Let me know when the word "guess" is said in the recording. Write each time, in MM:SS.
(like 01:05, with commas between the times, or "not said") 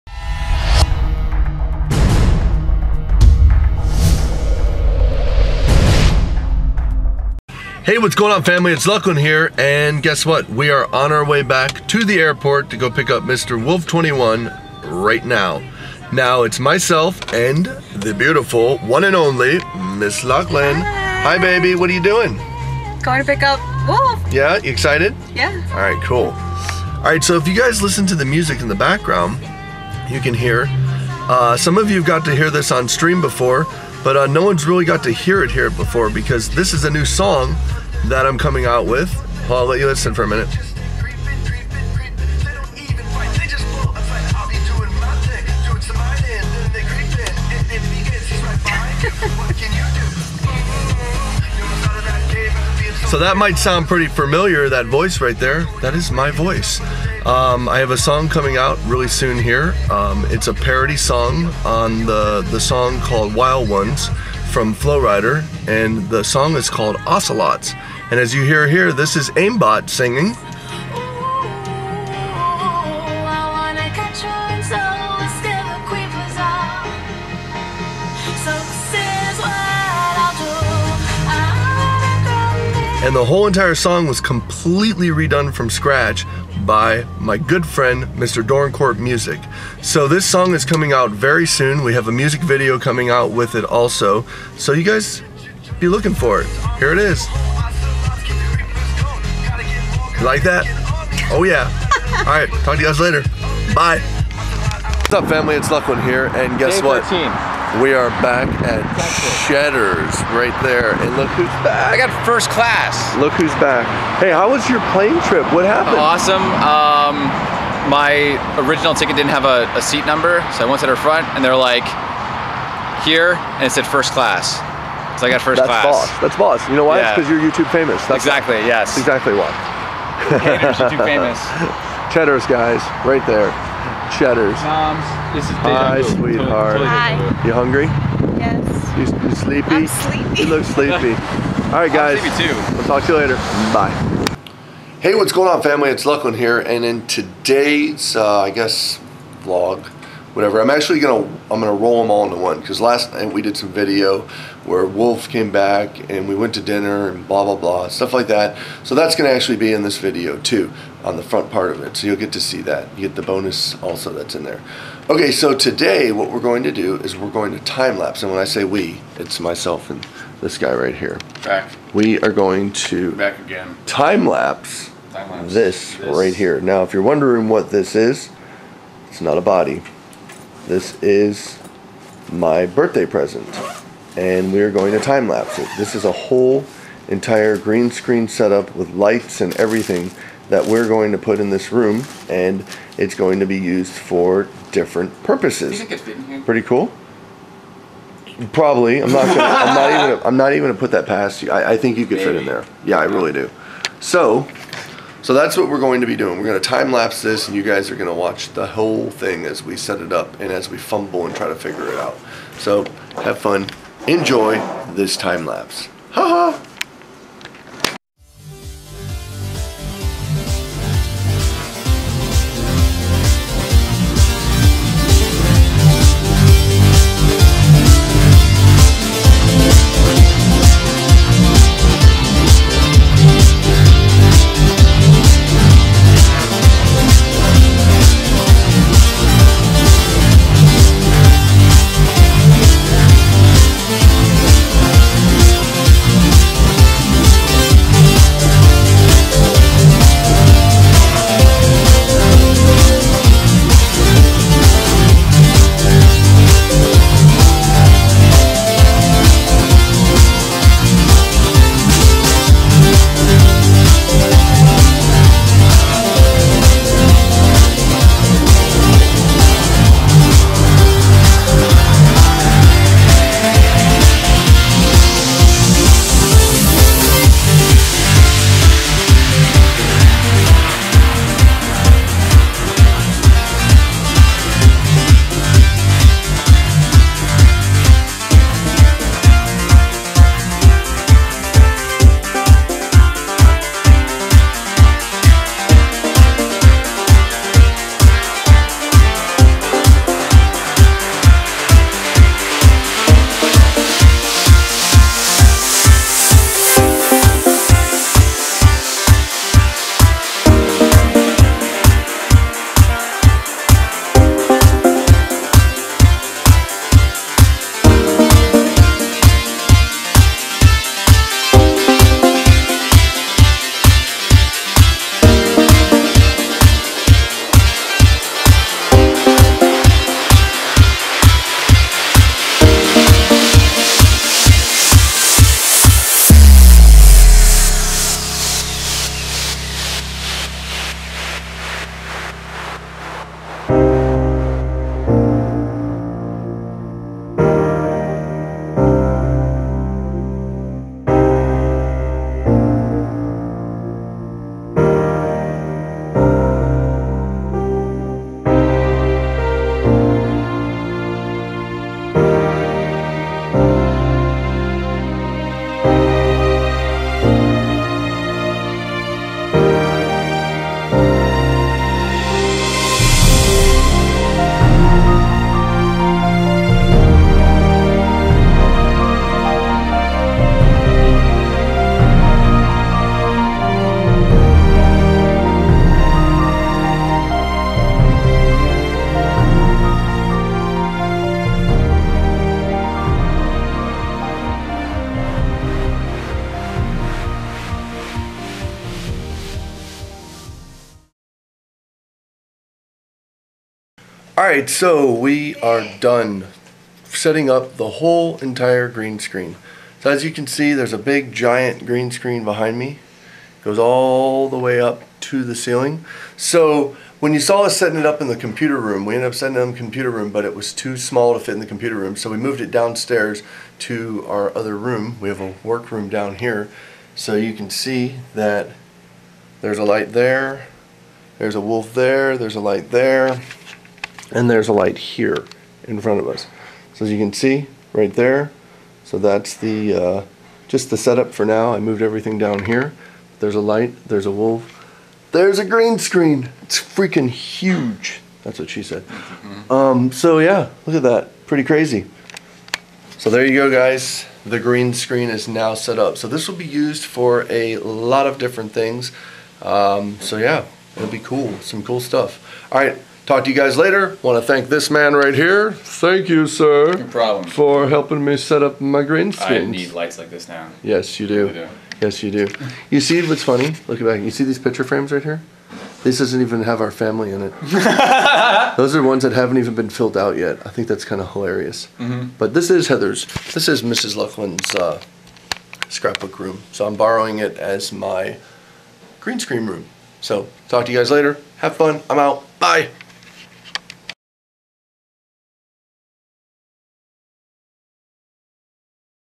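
00:10, 01:46, 02:28.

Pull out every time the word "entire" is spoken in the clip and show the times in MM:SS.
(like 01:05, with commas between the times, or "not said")
01:23, 03:07, 06:48.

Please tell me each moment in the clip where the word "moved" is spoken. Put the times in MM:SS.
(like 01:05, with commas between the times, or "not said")
07:02, 07:21.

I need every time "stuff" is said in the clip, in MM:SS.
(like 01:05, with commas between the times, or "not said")
02:37, 07:41.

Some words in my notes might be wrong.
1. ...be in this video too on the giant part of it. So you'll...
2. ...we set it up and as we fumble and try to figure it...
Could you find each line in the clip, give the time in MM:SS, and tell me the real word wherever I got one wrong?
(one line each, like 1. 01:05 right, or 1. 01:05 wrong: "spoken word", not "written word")
1. 02:39 wrong: "front", not "giant"
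2. 03:29 right.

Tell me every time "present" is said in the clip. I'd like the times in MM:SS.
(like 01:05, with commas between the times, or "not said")
03:03.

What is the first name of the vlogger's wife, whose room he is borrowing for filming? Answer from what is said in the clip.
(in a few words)
Heather.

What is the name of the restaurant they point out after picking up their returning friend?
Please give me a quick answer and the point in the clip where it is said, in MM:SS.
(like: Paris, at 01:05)
Cheddar's, at 01:49.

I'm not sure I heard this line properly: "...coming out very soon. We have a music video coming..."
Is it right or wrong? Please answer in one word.
right.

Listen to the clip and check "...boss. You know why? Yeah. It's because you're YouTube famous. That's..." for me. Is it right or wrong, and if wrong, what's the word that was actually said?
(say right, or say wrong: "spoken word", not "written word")
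right.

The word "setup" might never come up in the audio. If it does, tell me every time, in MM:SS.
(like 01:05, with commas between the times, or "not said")
03:08, 07:20.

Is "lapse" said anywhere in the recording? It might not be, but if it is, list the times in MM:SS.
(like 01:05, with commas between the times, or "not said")
02:47, 02:54, 03:05, 03:26, 03:35.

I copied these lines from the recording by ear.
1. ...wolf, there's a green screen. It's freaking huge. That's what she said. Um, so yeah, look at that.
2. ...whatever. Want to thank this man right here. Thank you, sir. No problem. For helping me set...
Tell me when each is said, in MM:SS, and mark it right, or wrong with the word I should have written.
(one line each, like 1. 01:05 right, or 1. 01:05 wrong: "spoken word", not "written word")
1. 07:24 right
2. 07:43 wrong: "later", not "whatever".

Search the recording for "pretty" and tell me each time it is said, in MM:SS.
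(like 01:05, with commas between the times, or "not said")
00:53, 03:16, 07:31.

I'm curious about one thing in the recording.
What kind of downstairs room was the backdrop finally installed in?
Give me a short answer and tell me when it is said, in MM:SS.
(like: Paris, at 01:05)
work room, at 07:05.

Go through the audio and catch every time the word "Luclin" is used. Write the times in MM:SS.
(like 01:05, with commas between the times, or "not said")
00:08, 00:20, 01:45, 02:26, 08:04.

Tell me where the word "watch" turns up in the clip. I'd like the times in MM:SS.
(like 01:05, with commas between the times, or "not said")
03:28.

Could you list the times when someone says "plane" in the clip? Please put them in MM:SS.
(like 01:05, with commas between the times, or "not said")
01:54.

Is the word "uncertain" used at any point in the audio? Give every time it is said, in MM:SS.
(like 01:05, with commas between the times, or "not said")
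not said.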